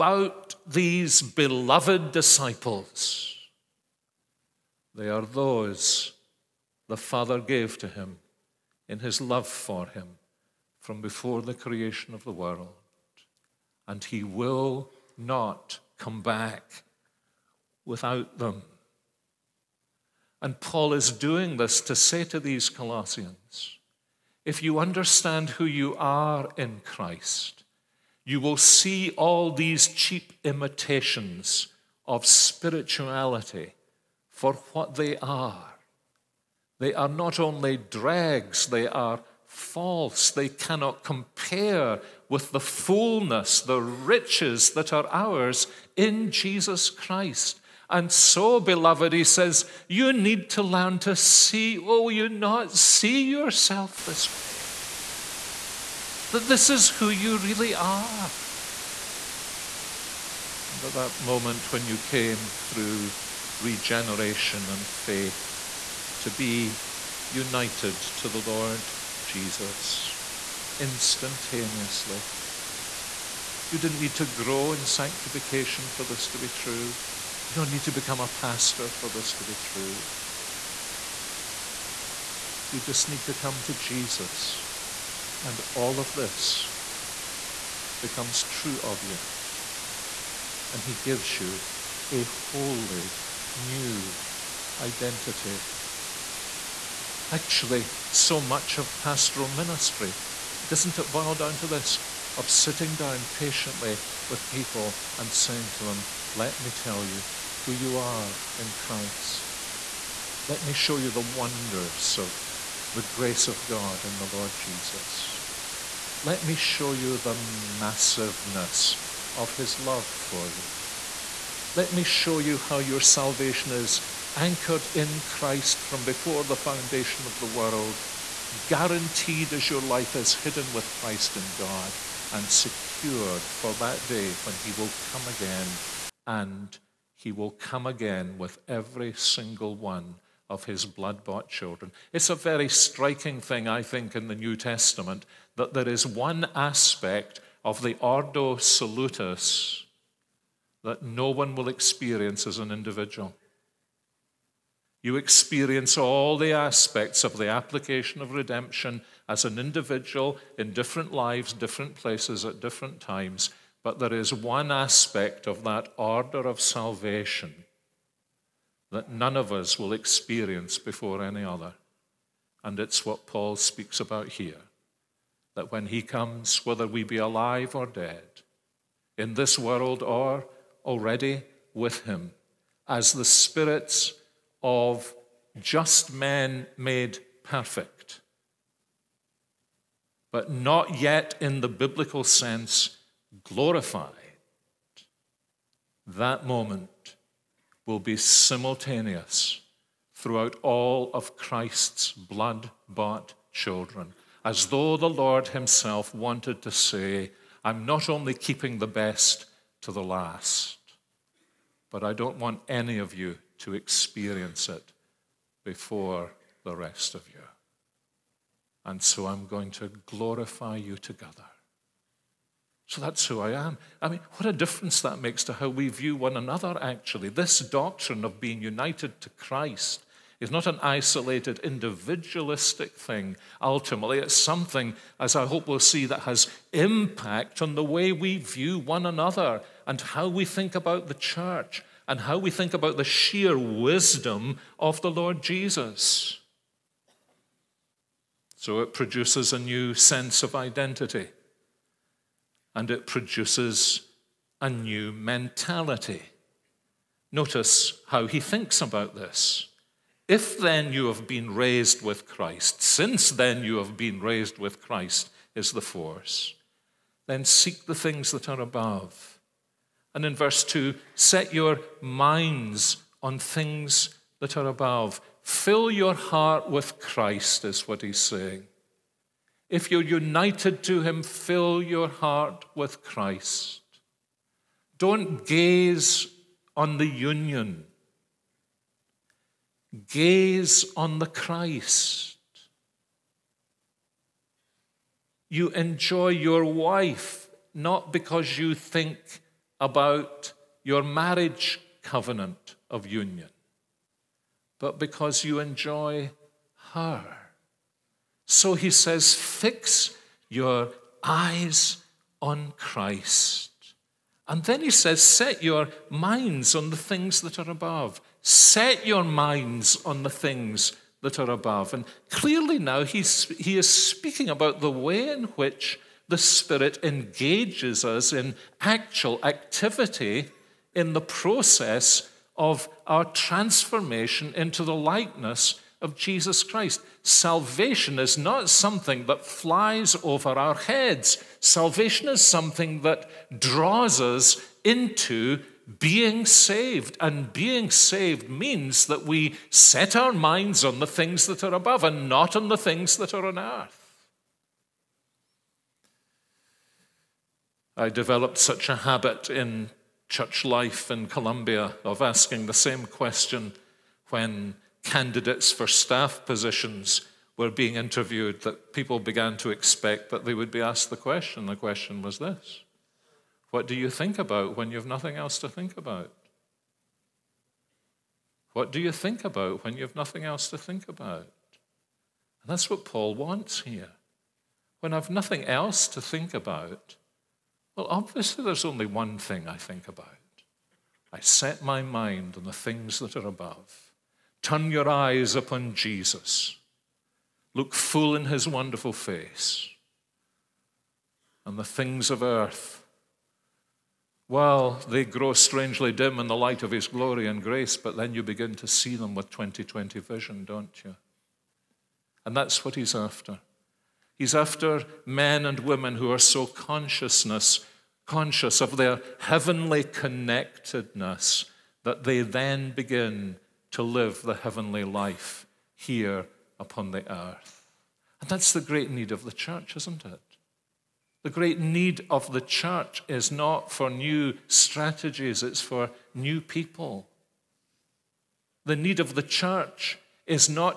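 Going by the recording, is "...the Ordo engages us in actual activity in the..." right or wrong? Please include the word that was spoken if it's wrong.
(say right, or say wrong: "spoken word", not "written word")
wrong: "Spirit", not "Ordo".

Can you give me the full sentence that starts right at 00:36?
They are not only dregs, they are false.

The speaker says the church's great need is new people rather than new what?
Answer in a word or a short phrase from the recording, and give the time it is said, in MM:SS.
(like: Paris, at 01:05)
Strategies, at 07:14.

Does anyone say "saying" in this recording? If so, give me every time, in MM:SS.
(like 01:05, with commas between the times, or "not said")
01:45, 04:38.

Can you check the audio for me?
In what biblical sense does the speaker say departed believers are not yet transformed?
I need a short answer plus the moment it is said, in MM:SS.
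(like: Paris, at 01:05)
Glorified, at 03:13.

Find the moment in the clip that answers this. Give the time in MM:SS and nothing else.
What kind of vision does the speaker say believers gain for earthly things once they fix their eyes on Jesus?
06:49.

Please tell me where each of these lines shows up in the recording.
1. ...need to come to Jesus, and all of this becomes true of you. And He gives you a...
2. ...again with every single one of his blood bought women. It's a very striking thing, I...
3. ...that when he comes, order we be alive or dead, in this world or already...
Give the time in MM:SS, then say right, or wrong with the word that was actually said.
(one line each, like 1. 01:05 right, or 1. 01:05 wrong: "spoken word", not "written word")
1. 01:23 right
2. 02:17 wrong: "children", not "women"
3. 02:55 wrong: "whether", not "order".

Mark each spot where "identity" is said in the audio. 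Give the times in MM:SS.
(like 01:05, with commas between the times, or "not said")
01:34, 04:10.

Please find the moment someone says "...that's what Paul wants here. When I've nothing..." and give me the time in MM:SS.
06:22.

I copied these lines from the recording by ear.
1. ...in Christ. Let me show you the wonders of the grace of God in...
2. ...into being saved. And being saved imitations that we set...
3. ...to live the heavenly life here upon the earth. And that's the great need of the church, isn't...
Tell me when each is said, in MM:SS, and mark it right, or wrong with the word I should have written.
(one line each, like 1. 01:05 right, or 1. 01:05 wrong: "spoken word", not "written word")
1. 01:48 right
2. 05:44 wrong: "means", not "imitations"
3. 07:03 right.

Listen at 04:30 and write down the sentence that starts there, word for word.
And in verse 2, set your minds on things that are above.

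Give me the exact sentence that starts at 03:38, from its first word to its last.
And so I'm going to glorify you together.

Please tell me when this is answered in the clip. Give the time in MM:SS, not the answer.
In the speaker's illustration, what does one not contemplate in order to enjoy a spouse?
05:01.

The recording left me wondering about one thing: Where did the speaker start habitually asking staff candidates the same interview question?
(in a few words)
Columbia.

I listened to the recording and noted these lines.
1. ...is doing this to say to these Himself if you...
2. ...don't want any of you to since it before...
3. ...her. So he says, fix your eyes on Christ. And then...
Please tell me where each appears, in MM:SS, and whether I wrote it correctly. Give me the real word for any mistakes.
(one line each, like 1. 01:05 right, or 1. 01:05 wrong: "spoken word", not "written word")
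1. 00:20 wrong: "Colossians", not "Himself"
2. 03:32 wrong: "experience", not "since"
3. 05:06 right.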